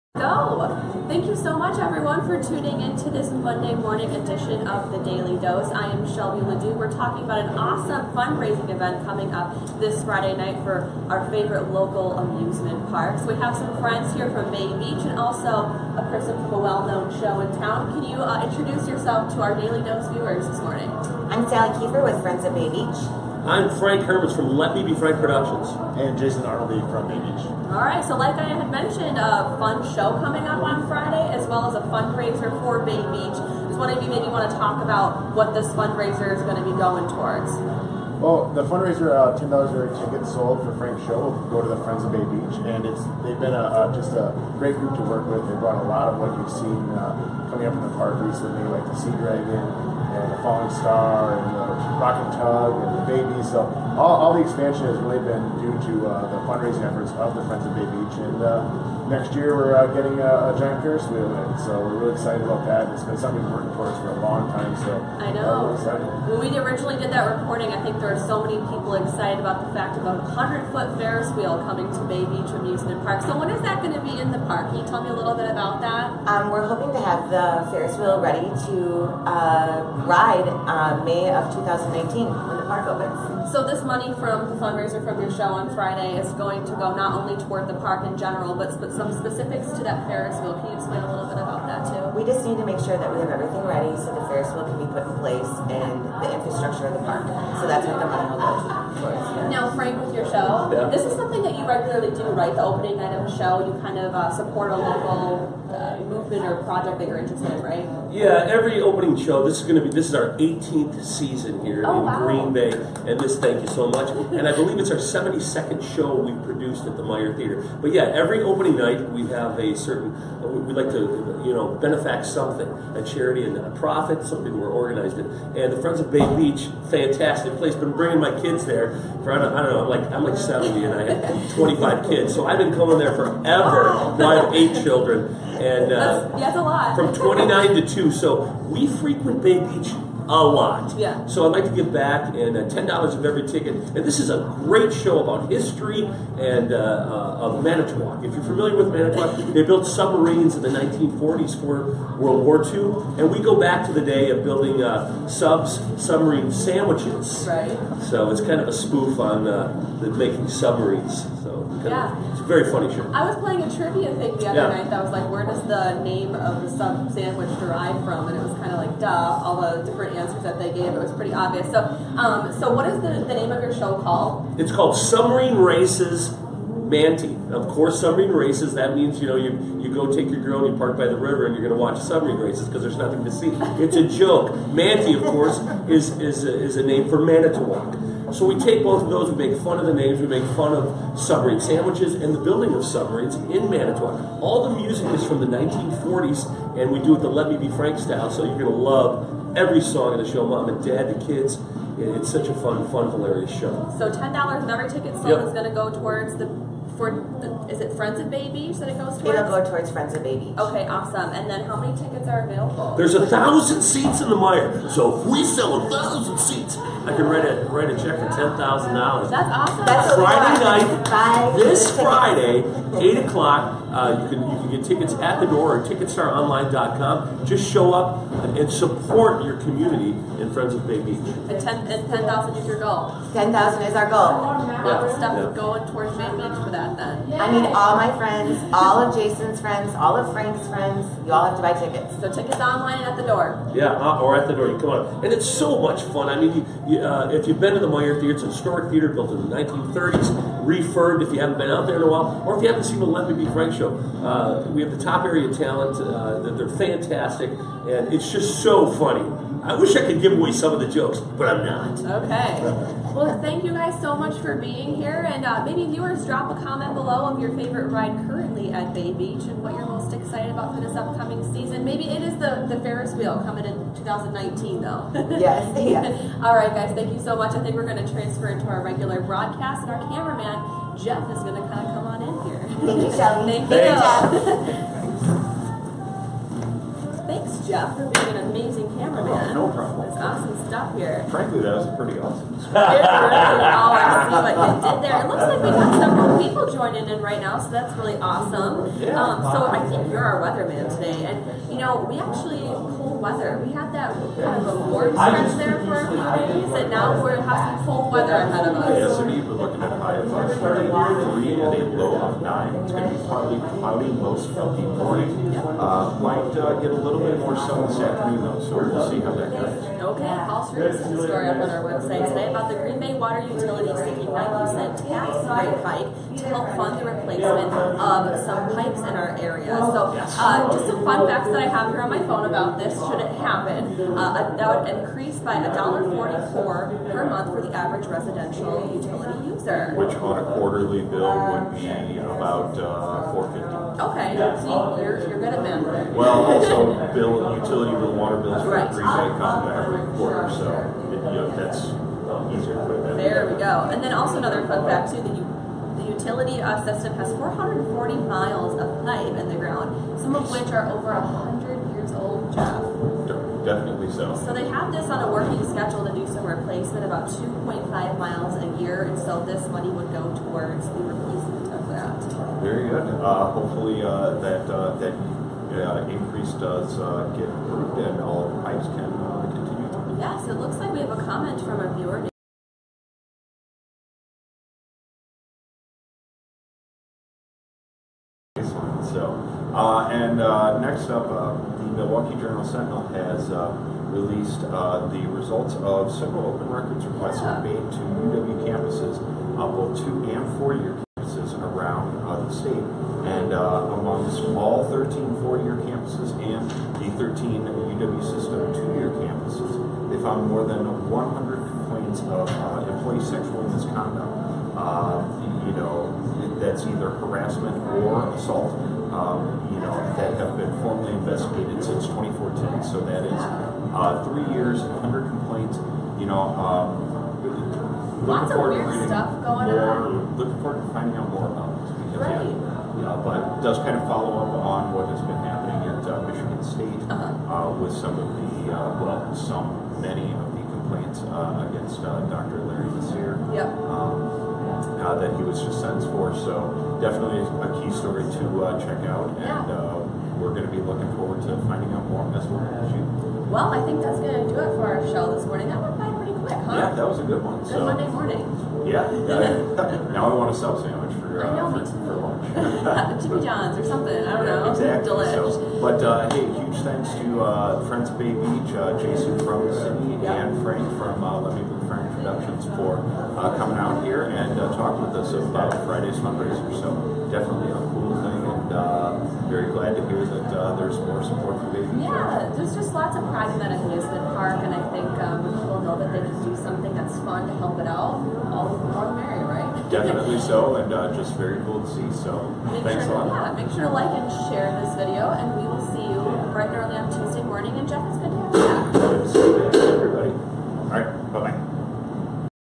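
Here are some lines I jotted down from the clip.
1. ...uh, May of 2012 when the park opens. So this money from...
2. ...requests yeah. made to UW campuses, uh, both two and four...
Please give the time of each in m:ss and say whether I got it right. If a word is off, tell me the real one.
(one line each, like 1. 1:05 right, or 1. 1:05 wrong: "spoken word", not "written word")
1. 1:20 wrong: "2019", not "2012"
2. 6:37 right.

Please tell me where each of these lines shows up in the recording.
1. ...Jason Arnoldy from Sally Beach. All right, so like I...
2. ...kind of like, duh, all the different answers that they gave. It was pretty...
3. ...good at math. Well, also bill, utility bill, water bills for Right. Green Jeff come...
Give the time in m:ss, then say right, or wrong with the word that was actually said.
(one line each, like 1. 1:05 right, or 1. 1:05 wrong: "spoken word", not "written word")
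1. 0:26 wrong: "Bay", not "Sally"
2. 2:48 right
3. 5:45 wrong: "Bay", not "Jeff".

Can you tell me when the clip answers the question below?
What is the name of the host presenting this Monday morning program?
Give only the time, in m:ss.
0:06.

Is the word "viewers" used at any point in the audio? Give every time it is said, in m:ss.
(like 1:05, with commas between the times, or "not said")
0:20, 4:25, 6:21.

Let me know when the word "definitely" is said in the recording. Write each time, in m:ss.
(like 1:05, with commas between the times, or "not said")
6:03, 7:27, 7:57, 8:09.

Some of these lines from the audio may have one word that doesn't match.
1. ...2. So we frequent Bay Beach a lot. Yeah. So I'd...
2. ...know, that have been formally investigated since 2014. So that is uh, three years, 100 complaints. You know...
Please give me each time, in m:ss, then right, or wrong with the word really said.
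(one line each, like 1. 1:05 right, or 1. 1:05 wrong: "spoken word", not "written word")
1. 2:17 right
2. 6:59 right.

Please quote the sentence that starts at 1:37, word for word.
So that's what the money will go Now, Frank, with your show, yeah.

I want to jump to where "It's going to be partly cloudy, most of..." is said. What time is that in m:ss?
5:12.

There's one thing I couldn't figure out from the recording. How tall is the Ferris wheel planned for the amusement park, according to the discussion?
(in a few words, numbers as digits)
100 foot.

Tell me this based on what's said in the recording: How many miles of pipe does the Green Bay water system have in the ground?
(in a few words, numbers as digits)
440.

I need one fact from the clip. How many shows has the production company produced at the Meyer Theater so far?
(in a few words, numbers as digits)
72.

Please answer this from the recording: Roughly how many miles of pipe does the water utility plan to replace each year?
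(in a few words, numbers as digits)
2.5.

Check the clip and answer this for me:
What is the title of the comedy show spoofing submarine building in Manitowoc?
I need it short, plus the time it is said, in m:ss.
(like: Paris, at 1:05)
Submarine Races Manty, at 2:54.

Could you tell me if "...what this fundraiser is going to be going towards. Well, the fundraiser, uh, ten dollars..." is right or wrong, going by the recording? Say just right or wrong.
right.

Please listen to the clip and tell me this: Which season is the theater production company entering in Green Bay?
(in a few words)
18th.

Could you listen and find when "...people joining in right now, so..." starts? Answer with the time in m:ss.
4:56.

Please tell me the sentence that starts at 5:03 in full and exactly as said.
We had that kind of a warm stretch there for a few days, and now we're having cold weather ahead of us.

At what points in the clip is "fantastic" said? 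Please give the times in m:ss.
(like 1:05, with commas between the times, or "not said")
2:06, 4:16.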